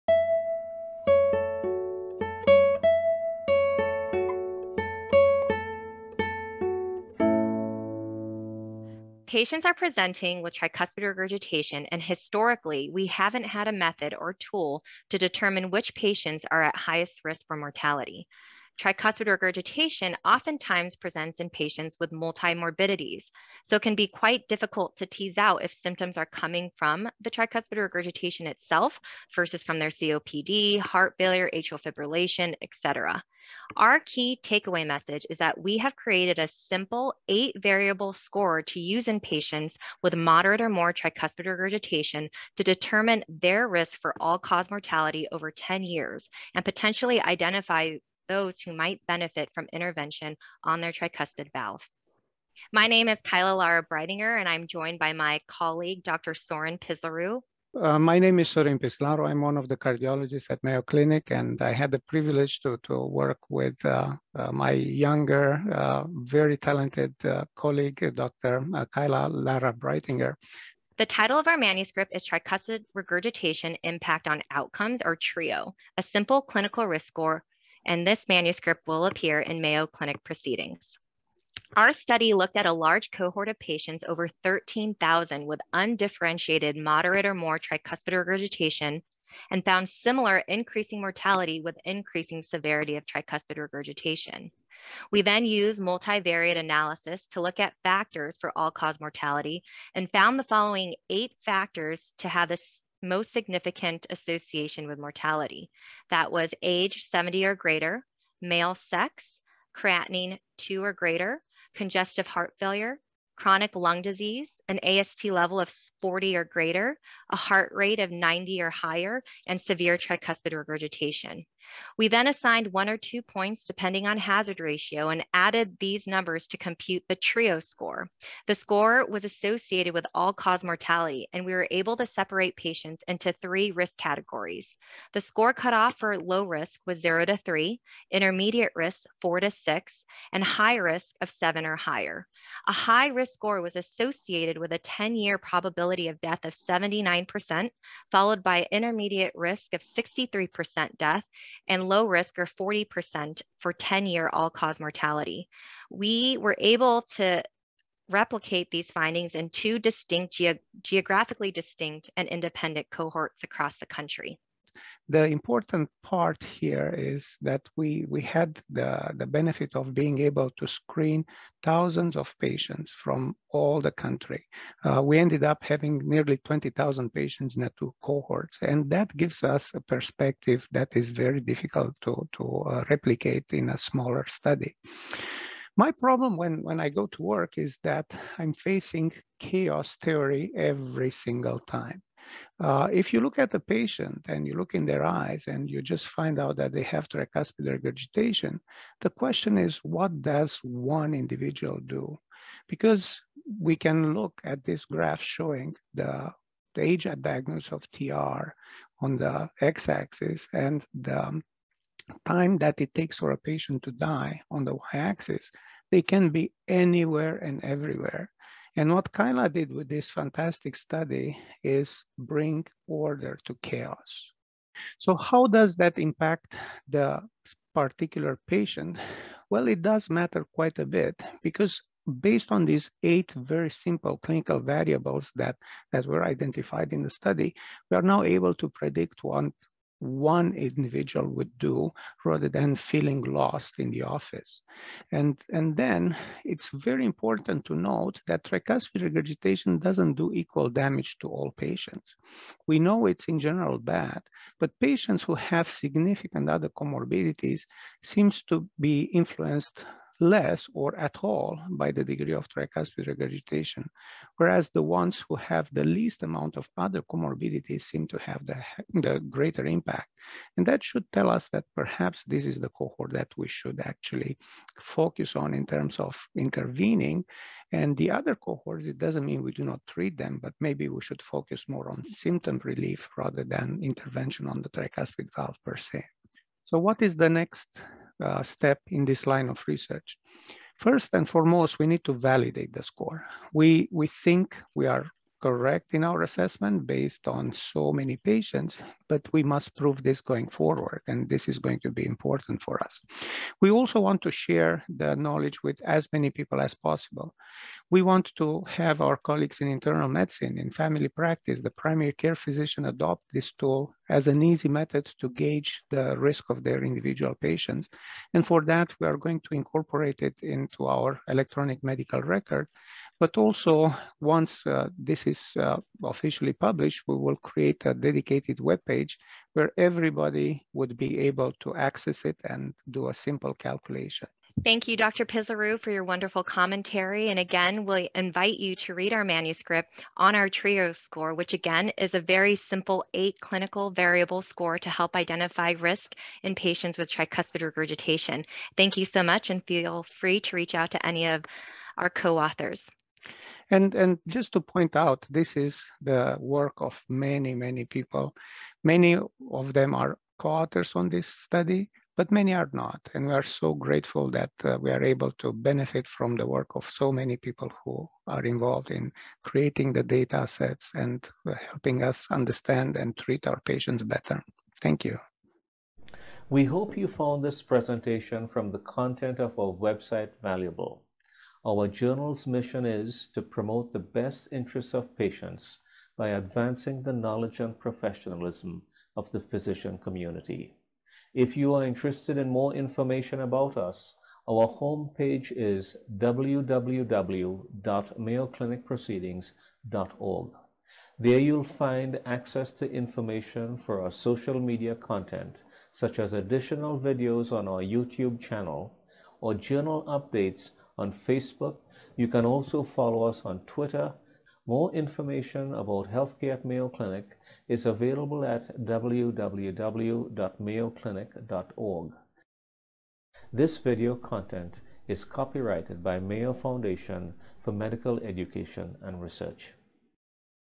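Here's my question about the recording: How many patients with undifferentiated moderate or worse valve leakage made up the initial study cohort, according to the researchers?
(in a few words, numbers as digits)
over 13,000.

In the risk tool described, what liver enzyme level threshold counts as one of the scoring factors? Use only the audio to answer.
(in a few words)
AST 40 or greater.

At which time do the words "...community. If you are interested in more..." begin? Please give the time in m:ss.
6:29.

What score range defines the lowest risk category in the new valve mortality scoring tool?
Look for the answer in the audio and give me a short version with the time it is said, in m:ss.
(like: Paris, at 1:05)
0 to 3, at 2:17.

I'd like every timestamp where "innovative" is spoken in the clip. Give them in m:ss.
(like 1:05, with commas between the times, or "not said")
not said.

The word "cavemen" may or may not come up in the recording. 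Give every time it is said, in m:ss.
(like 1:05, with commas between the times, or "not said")
not said.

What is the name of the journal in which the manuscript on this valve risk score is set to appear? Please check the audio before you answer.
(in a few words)
Mayo Clinic Proceedings.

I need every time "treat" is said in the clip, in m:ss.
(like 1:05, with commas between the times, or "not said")
4:39, 6:13.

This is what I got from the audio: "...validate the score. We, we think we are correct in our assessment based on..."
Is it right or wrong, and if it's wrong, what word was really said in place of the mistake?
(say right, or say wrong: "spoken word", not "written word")
right.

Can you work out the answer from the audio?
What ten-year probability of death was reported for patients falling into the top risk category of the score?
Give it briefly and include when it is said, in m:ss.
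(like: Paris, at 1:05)
79%, at 2:26.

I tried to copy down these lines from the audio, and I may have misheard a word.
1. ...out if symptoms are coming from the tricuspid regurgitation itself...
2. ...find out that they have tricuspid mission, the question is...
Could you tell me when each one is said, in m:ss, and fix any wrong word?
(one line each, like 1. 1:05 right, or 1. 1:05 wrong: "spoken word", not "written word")
1. 0:25 right
2. 3:16 wrong: "regurgitation", not "mission".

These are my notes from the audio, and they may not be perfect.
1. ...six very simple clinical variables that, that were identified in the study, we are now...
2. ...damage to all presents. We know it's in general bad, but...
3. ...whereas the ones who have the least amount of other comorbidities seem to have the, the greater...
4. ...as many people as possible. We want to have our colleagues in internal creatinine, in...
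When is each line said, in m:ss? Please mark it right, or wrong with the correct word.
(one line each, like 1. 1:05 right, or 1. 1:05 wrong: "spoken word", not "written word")
1. 3:53 wrong: "eight", not "six"
2. 4:10 wrong: "patients", not "presents"
3. 4:24 right
4. 5:05 wrong: "medicine", not "creatinine".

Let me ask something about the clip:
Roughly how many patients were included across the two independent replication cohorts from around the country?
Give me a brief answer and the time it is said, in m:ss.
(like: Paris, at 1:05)
nearly 20,000, at 2:56.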